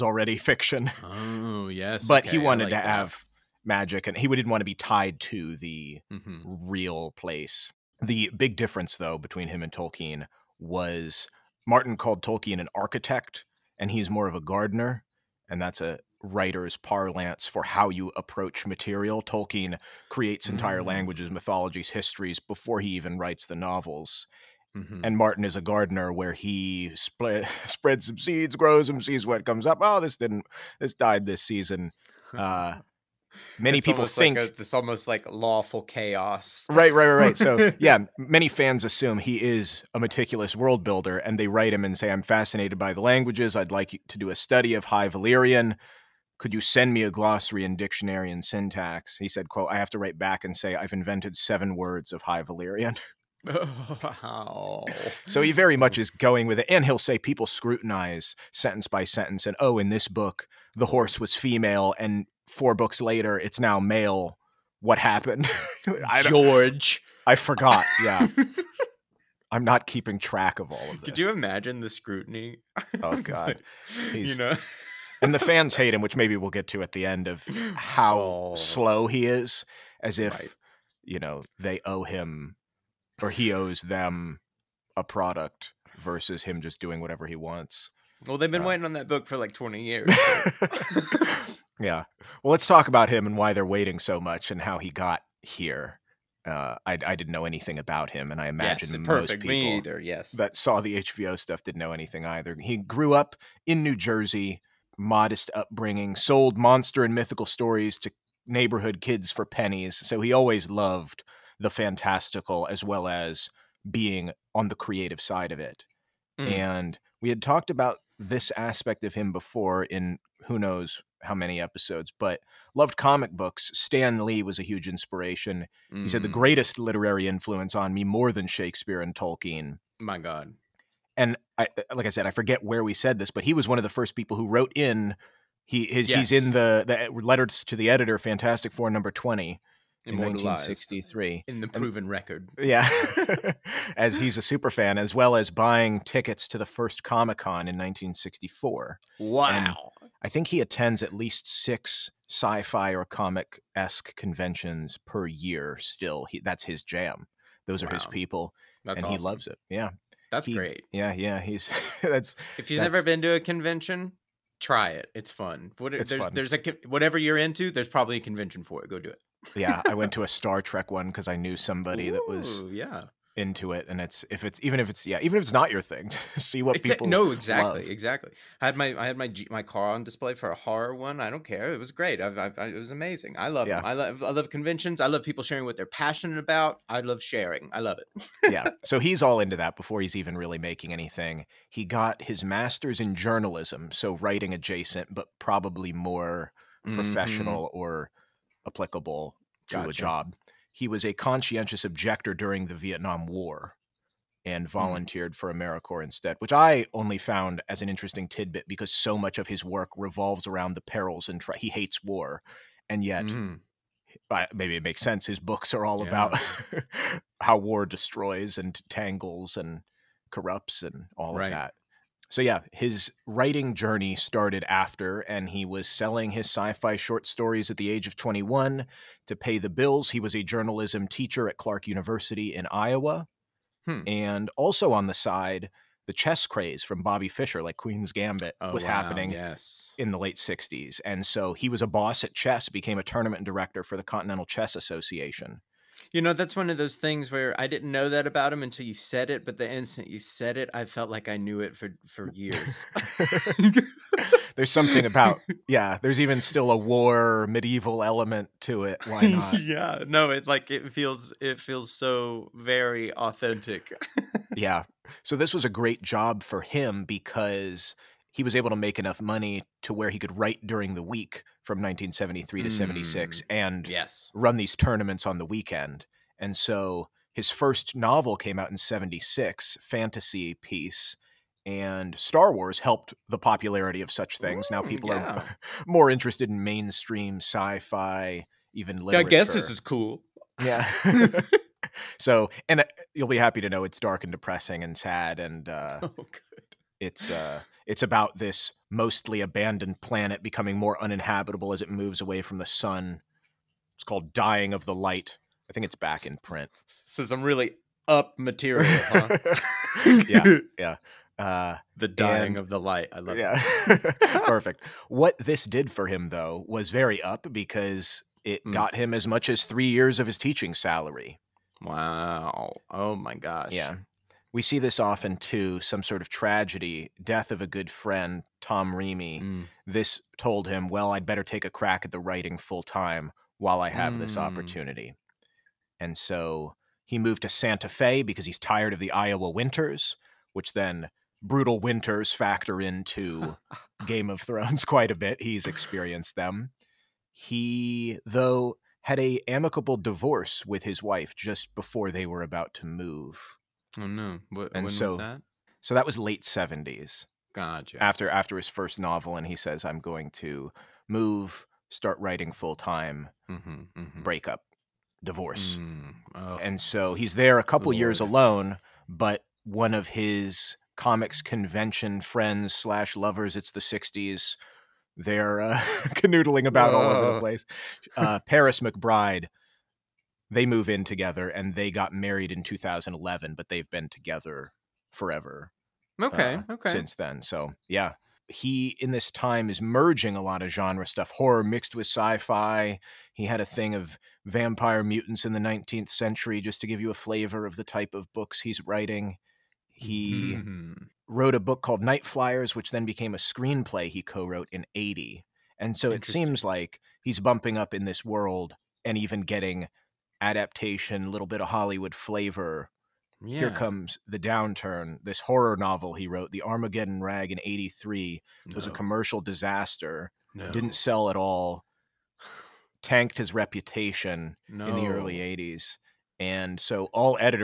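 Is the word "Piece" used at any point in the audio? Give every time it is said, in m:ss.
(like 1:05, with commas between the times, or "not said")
4:40.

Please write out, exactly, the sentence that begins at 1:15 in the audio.
and the fans hate him, which maybe we'll get to at the end of how oh.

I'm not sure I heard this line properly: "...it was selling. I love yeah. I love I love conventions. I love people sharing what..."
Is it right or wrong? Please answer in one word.
wrong.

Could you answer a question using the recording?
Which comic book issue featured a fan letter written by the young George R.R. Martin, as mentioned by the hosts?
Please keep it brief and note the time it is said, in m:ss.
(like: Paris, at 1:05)
Fantastic Four number 20, at 2:18.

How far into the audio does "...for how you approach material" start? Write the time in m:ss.
0:17.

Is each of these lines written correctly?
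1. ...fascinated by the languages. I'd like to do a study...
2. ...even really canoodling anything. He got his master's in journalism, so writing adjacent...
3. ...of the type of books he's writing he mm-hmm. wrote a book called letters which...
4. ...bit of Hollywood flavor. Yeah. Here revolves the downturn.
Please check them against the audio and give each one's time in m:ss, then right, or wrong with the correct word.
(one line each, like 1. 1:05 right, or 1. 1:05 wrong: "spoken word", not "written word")
1. 0:42 right
2. 3:10 wrong: "making", not "canoodling"
3. 6:37 wrong: "nightflyers", not "letters"
4. 6:51 wrong: "comes", not "revolves".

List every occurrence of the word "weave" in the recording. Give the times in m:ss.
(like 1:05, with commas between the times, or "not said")
not said.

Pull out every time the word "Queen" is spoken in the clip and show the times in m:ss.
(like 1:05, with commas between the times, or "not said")
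3:57.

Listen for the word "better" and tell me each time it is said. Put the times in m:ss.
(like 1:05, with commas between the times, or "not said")
5:31.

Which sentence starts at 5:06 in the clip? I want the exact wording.
So some really up material, huh?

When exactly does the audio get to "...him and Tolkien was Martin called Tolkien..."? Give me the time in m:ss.
0:09.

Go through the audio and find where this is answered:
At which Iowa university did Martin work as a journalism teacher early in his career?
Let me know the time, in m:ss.
3:51.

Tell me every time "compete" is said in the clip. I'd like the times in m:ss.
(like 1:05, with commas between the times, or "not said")
not said.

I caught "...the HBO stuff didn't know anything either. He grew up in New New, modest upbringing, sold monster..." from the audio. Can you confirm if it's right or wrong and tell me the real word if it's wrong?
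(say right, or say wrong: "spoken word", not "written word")
wrong: "Jersey", not "New".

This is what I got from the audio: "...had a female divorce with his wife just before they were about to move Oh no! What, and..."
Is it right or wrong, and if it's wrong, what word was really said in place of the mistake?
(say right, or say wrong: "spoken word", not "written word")
wrong: "amicable", not "female".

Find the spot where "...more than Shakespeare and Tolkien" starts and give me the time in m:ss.
2:08.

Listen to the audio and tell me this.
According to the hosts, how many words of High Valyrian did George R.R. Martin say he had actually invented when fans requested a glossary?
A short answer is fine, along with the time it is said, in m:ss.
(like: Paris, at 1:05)
7, at 0:51.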